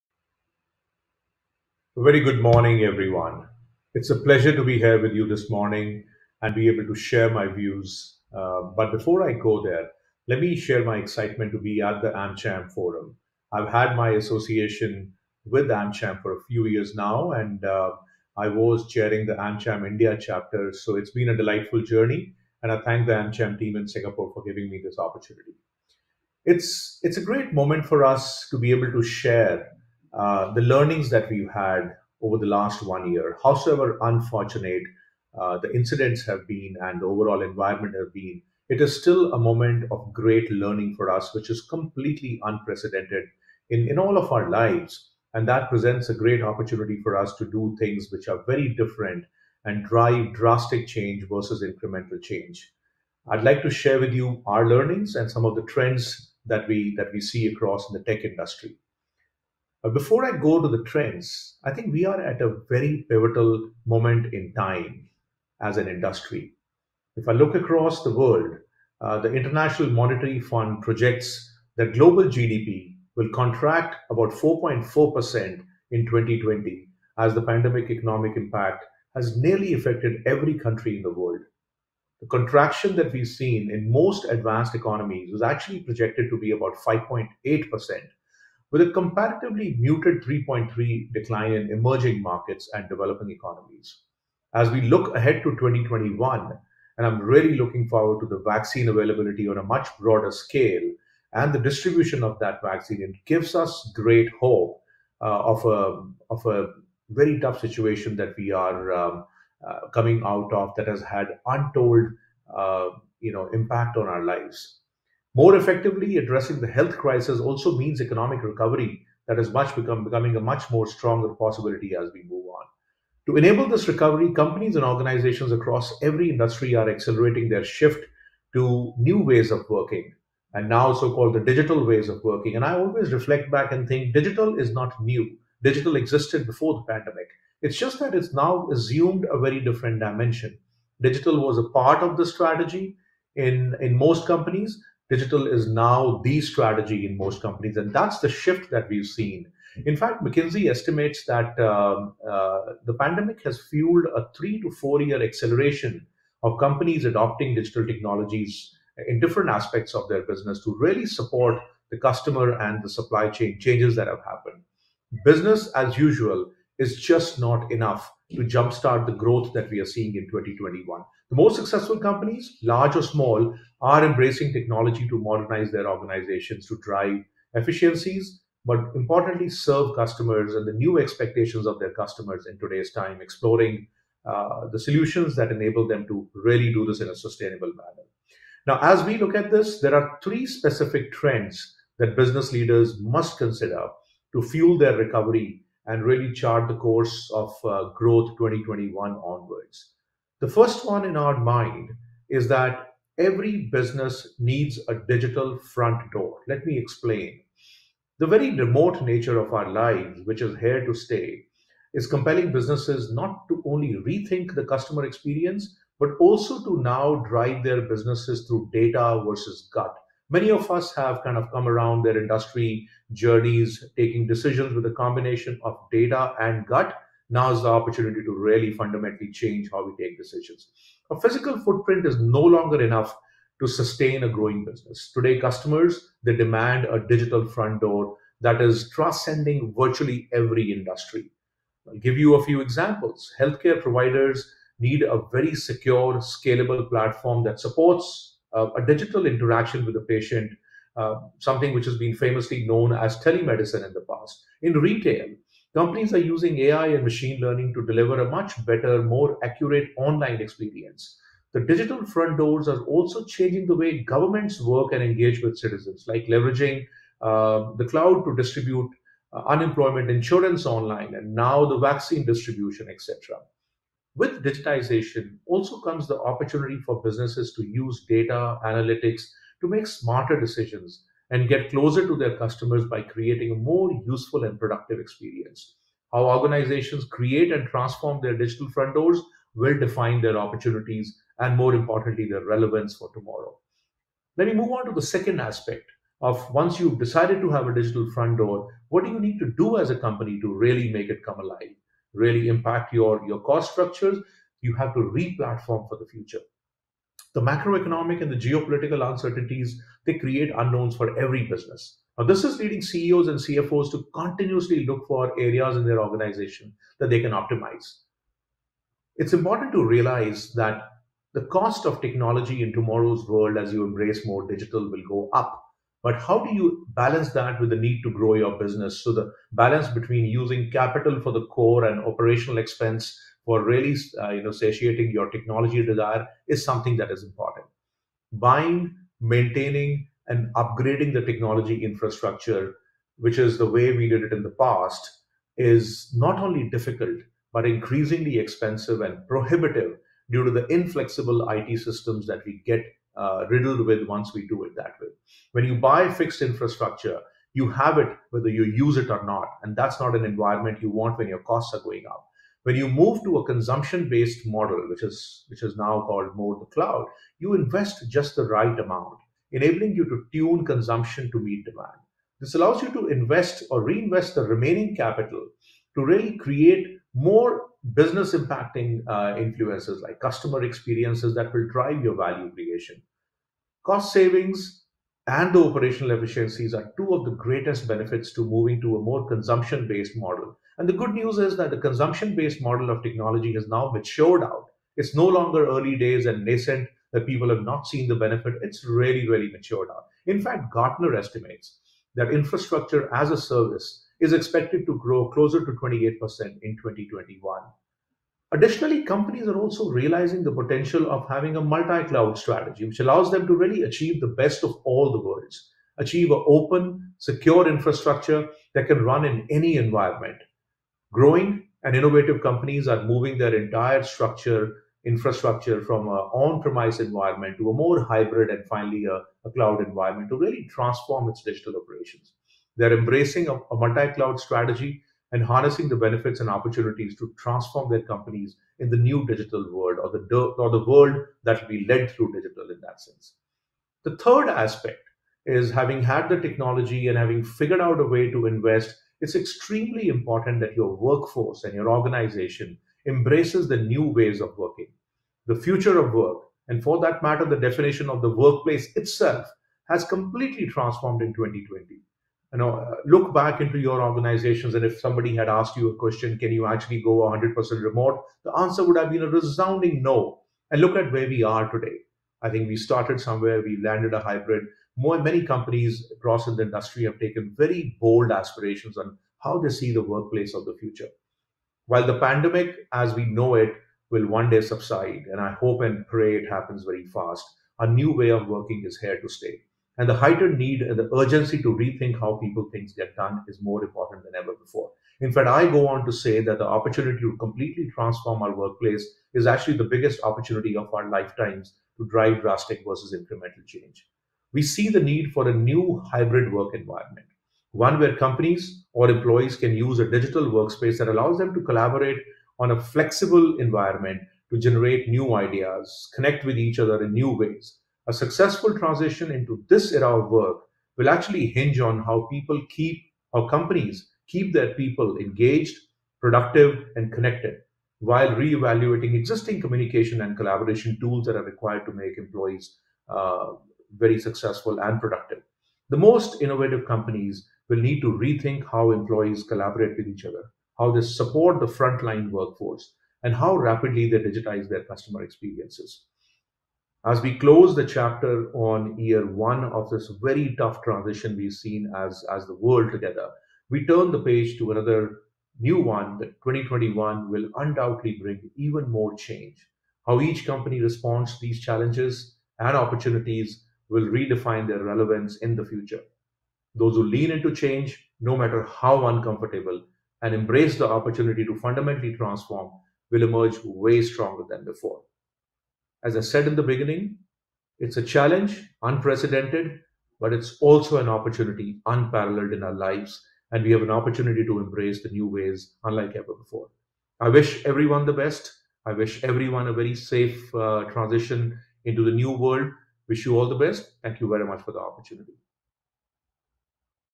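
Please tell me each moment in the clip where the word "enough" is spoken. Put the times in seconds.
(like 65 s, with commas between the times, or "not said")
167 s, 232 s.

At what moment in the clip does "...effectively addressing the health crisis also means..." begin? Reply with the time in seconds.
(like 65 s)
115 s.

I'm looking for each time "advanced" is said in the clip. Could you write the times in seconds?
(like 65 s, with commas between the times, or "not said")
84 s.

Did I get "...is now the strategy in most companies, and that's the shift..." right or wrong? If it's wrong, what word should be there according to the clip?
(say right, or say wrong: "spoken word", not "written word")
right.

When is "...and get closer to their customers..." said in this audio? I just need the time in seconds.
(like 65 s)
281 s.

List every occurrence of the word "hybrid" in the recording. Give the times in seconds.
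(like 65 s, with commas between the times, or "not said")
428 s, 474 s, 506 s.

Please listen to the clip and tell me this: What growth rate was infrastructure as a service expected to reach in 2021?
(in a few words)
28%.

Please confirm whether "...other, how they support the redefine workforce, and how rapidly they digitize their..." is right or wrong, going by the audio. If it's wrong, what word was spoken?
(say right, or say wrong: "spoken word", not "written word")
wrong: "frontline", not "redefine".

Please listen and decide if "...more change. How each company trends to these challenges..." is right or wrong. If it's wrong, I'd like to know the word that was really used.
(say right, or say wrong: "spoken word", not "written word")
wrong: "responds", not "trends".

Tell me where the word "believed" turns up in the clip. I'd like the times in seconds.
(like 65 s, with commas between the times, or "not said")
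not said.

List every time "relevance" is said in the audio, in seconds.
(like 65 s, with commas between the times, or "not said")
292 s, 564 s.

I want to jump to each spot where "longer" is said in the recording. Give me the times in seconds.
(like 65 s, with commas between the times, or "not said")
232 s, 395 s.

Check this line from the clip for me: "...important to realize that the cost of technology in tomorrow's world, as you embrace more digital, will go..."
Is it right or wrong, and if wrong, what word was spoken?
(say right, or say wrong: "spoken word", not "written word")
right.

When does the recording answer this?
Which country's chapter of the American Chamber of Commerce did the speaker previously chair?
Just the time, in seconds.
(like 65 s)
19 s.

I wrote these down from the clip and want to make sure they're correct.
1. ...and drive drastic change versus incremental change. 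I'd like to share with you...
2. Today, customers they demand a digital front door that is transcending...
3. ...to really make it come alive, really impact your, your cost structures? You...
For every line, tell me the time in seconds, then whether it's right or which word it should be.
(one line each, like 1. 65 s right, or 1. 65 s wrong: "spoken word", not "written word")
1. 49 s right
2. 235 s right
3. 300 s right.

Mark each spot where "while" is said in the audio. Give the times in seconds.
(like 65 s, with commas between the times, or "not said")
481 s, 527 s.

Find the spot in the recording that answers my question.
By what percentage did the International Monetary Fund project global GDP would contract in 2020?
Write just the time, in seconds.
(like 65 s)
74 s.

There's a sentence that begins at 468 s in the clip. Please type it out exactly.
The answer would have been a resounding no.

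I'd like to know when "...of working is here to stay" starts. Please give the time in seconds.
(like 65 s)
488 s.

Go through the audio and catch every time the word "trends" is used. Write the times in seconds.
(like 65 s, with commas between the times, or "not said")
55 s, 60 s, 191 s.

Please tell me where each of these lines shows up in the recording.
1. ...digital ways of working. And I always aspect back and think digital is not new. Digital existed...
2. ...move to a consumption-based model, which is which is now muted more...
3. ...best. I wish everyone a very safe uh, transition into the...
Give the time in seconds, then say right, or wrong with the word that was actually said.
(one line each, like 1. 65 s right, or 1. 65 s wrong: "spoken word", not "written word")
1. 131 s wrong: "reflect", not "aspect"
2. 362 s wrong: "called", not "muted"
3. 588 s right.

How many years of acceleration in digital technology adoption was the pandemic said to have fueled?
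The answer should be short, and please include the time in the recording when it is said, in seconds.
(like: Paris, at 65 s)
3 to 4 years, at 154 s.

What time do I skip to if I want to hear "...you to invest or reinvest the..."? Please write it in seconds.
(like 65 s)
372 s.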